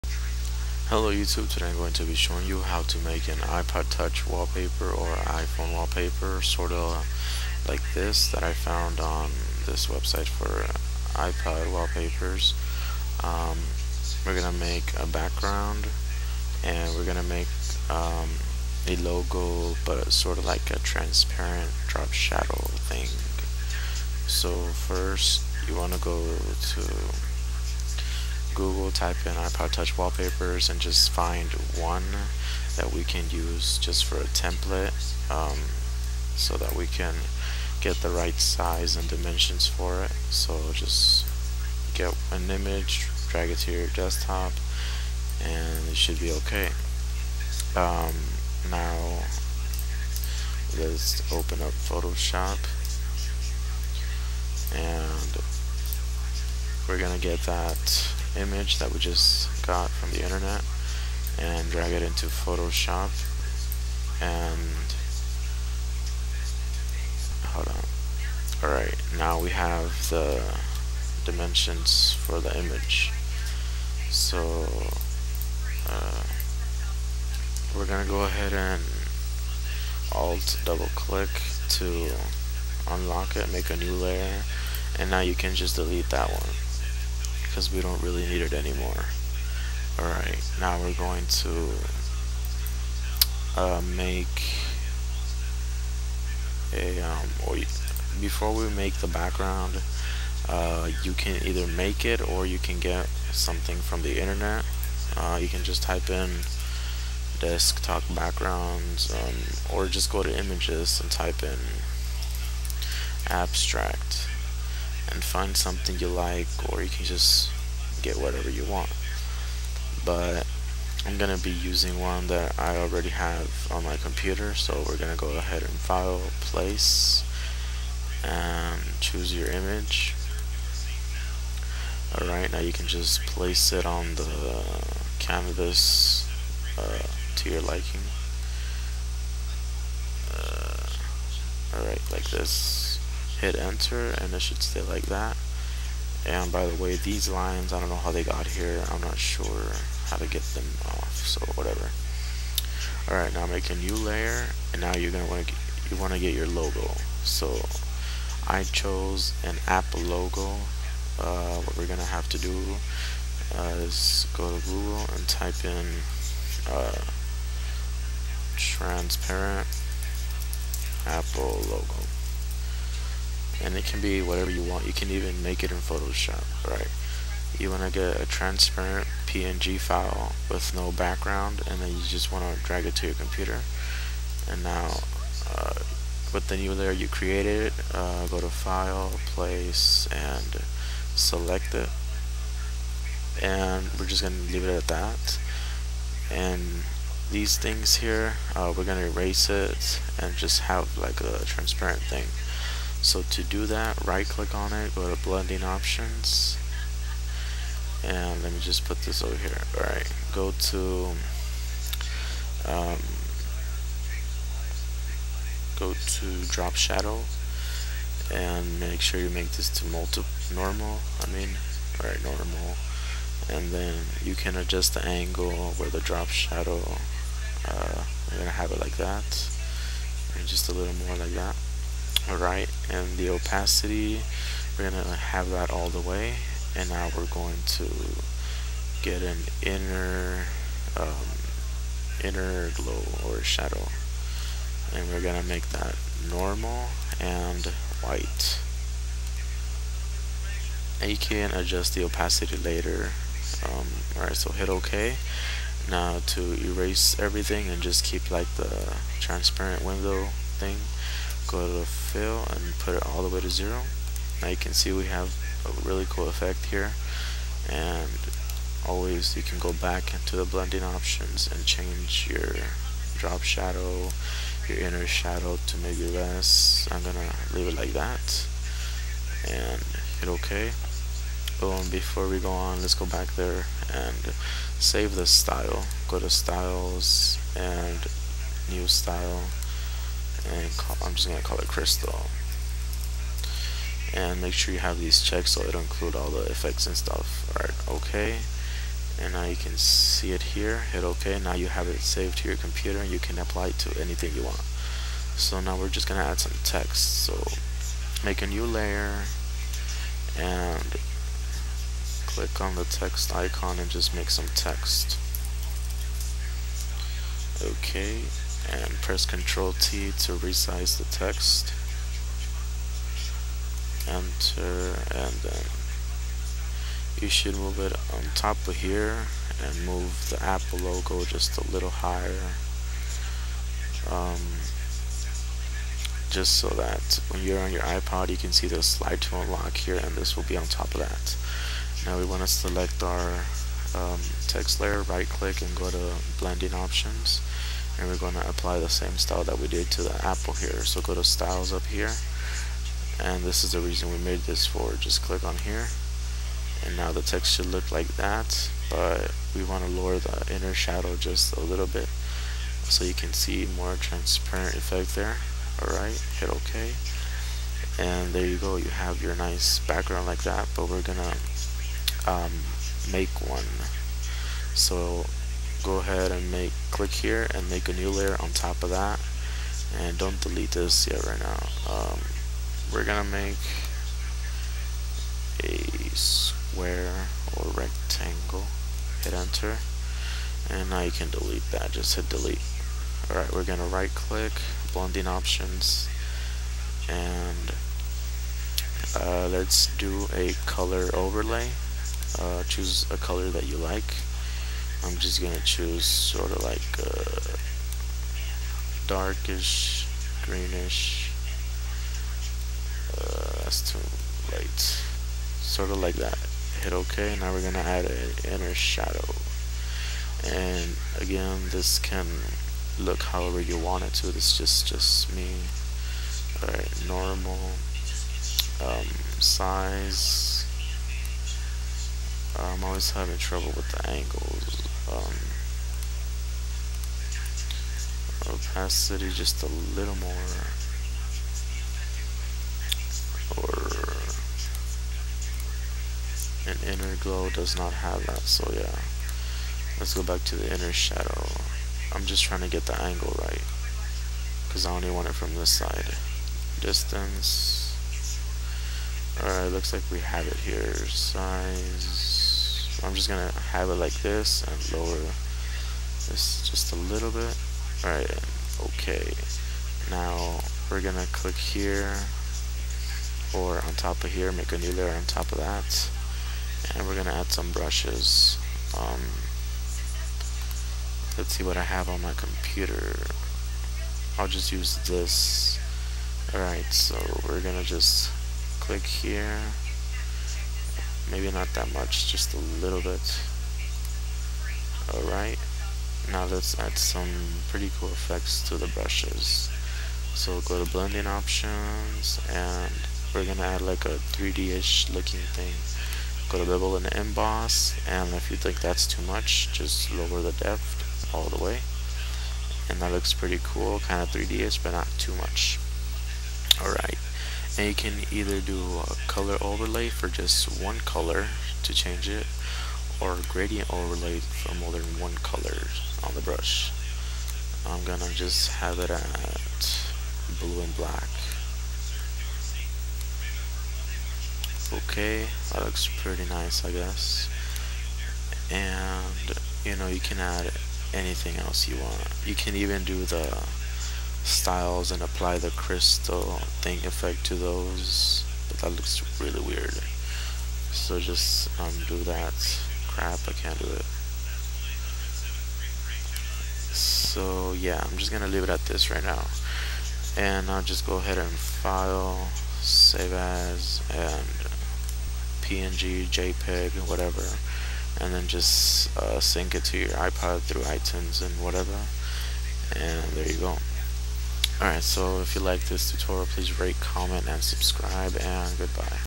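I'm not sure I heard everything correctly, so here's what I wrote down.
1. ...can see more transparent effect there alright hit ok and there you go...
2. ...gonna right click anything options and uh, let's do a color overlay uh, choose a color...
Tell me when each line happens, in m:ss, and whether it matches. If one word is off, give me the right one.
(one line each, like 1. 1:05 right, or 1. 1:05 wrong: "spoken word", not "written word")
1. 6:03 right
2. 6:33 wrong: "blending", not "anything".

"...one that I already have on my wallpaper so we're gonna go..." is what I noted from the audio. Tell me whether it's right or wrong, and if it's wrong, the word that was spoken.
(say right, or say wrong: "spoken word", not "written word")
wrong: "computer", not "wallpaper".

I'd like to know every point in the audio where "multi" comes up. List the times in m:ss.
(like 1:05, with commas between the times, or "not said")
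3:39.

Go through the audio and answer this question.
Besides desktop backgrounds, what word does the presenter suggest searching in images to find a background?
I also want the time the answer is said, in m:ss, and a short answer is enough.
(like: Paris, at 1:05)
abstract, at 1:53.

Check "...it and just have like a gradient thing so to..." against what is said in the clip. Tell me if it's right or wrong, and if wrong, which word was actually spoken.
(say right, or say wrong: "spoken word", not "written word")
wrong: "transparent", not "gradient".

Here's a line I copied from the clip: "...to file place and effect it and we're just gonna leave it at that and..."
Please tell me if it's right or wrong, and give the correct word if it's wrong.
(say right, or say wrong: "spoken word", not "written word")
wrong: "select", not "effect".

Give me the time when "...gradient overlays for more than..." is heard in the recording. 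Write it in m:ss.
8:43.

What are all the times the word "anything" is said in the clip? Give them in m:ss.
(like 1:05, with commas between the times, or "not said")
5:04, 9:01.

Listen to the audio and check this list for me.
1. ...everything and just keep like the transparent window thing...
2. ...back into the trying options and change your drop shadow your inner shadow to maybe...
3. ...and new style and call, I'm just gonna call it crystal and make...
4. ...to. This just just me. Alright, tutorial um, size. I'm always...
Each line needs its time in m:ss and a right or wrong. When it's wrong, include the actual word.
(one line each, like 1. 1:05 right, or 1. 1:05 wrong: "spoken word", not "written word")
1. 4:17 right
2. 4:29 wrong: "blending", not "trying"
3. 4:47 right
4. 7:04 wrong: "normal", not "tutorial".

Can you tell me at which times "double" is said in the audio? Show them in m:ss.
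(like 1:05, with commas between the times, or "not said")
1:20.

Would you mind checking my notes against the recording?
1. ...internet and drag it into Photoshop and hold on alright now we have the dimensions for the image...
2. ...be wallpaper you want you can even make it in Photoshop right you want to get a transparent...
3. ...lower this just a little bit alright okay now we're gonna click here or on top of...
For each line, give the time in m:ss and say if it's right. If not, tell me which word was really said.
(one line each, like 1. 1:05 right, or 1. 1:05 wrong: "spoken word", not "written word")
1. 1:00 right
2. 2:54 wrong: "whatever", not "wallpaper"
3. 7:44 right.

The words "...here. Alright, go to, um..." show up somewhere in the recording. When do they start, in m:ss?
3:29.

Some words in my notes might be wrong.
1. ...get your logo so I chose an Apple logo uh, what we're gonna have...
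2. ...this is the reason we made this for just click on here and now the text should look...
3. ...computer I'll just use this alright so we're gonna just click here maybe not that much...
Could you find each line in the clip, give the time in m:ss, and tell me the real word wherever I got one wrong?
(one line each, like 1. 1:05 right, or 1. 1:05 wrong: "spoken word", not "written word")
1. 2:36 right
2. 5:53 right
3. 8:02 right.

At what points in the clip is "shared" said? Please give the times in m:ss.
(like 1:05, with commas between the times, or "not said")
not said.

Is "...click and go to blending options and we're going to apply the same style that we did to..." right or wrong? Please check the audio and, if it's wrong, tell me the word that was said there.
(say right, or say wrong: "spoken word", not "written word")
right.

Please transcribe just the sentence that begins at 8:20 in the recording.
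So we'll go to blending options and we're gonna add like a 3D-ish looking thing.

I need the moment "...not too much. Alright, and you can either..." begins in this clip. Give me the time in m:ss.
8:34.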